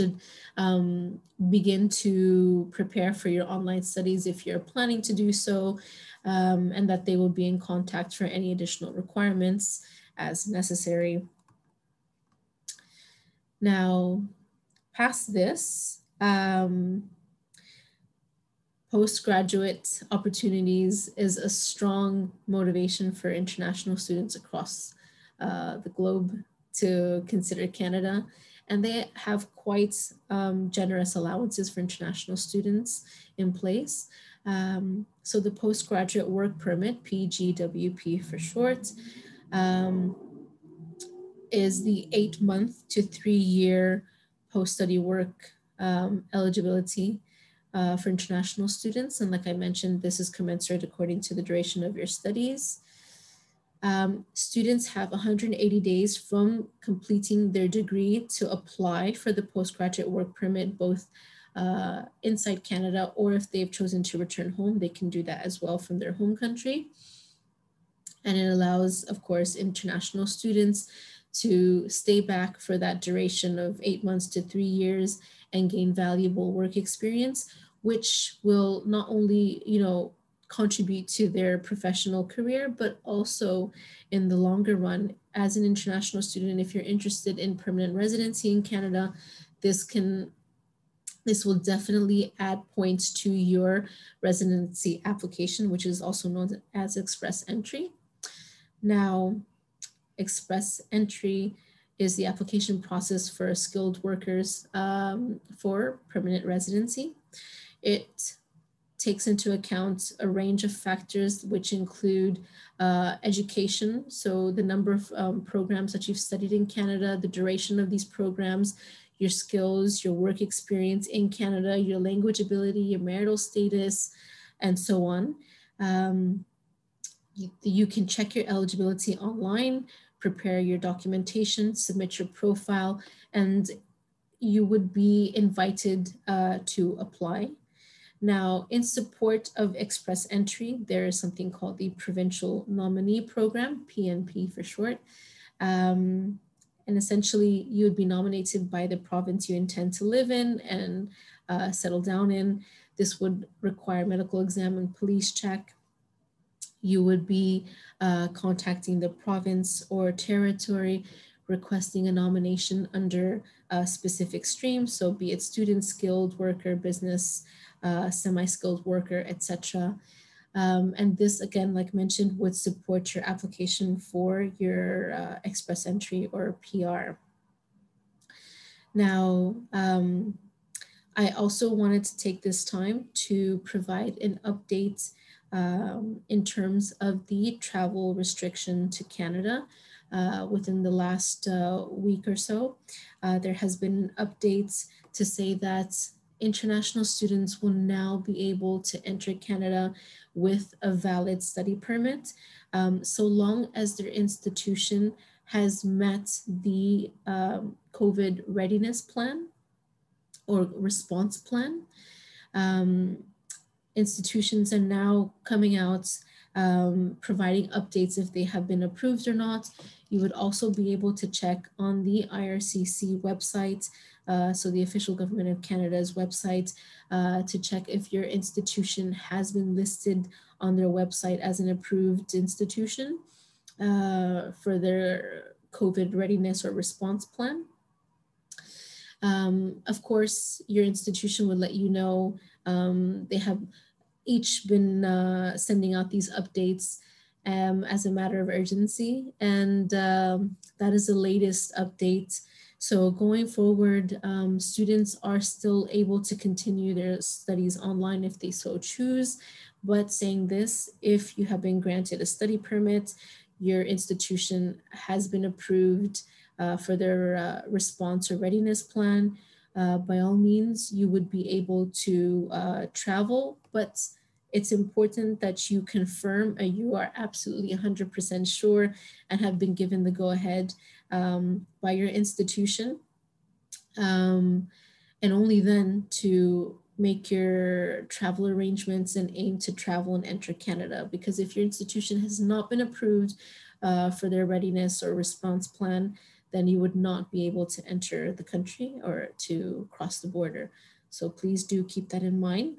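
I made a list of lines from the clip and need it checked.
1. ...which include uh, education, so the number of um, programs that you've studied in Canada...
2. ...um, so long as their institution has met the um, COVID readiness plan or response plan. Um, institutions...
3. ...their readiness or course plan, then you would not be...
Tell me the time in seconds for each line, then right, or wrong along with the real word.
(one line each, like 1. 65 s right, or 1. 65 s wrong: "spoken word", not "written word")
1. 111 s right
2. 202 s right
3. 294 s wrong: "response", not "course".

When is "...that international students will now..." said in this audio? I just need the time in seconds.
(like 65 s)
195 s.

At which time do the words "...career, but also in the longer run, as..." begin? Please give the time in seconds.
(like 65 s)
82 s.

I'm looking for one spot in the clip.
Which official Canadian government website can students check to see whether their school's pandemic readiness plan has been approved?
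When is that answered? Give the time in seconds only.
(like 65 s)
222 s.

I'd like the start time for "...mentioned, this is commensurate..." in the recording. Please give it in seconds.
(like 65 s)
49 s.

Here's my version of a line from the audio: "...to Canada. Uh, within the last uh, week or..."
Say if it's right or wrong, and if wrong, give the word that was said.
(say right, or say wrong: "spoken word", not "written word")
right.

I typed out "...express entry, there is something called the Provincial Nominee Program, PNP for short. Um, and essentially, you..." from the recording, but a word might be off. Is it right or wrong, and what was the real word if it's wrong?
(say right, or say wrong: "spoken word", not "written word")
right.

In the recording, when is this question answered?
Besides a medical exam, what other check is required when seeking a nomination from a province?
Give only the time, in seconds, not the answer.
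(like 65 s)
154 s.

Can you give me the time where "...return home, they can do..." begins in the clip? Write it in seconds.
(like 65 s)
64 s.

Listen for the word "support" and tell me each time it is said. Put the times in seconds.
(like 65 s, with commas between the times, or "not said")
138 s, 172 s.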